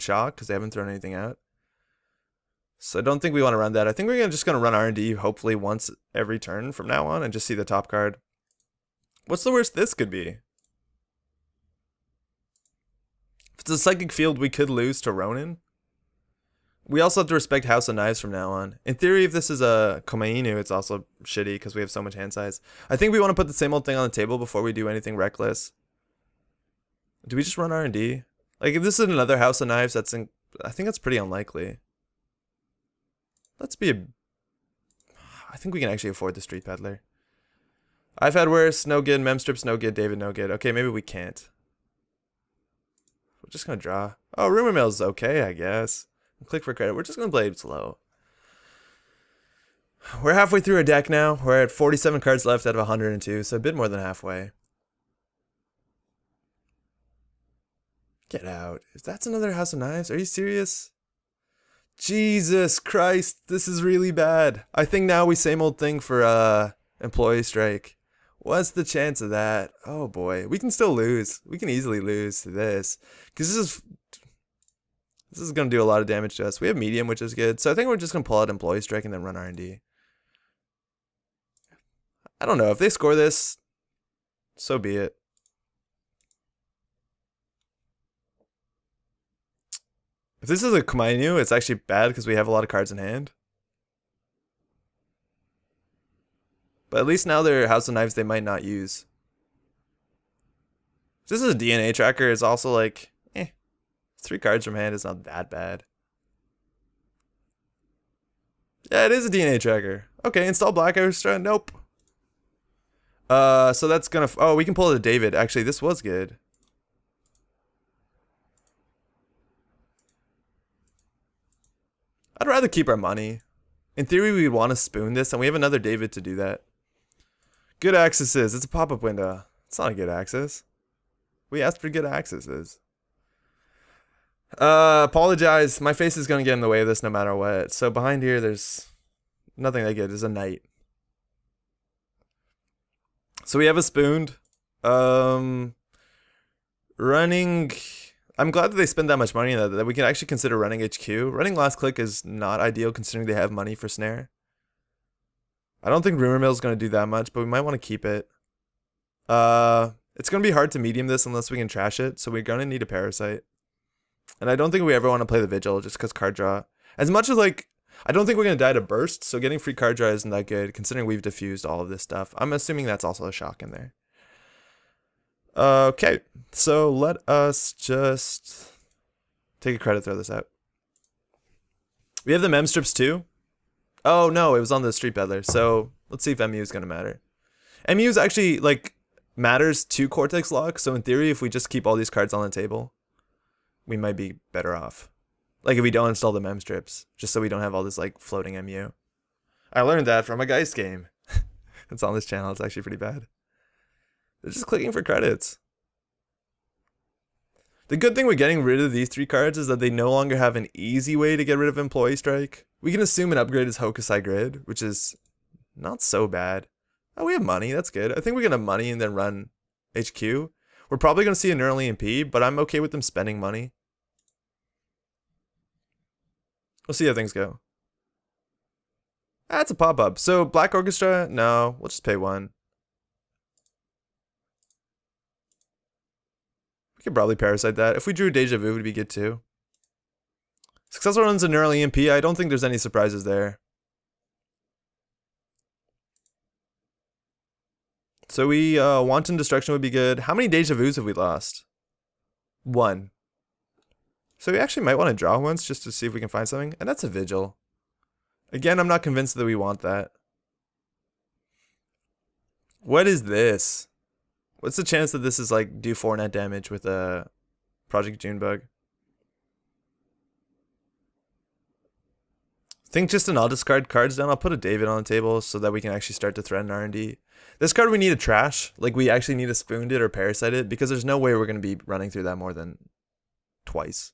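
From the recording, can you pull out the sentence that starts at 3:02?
We have the mem strips too, Oh no, it was on the Street Peddler.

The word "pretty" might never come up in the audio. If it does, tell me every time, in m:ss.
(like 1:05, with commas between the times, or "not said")
0:30, 3:22.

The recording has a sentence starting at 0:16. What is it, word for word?
We also have to respect House of Knives from now on.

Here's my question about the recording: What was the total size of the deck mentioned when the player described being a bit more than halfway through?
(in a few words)
102.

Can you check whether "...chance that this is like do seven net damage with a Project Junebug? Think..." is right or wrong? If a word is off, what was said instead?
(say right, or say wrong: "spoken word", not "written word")
wrong: "four", not "seven".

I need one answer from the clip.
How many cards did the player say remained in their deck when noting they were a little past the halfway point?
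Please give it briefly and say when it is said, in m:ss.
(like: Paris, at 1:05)
47, at 0:51.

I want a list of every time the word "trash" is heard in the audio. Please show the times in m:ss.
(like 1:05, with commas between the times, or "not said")
2:41, 4:38.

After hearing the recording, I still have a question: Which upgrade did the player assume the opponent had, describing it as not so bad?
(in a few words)
Hokusai Grid.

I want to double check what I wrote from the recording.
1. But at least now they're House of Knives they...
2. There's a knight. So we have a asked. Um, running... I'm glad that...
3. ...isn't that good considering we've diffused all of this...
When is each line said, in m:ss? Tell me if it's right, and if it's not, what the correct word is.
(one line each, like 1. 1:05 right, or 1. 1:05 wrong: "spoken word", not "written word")
1. 1:36 right
2. 2:20 wrong: "spooned", not "asked"
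3. 2:50 right.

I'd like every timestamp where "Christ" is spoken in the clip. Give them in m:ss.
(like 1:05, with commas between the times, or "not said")
1:02.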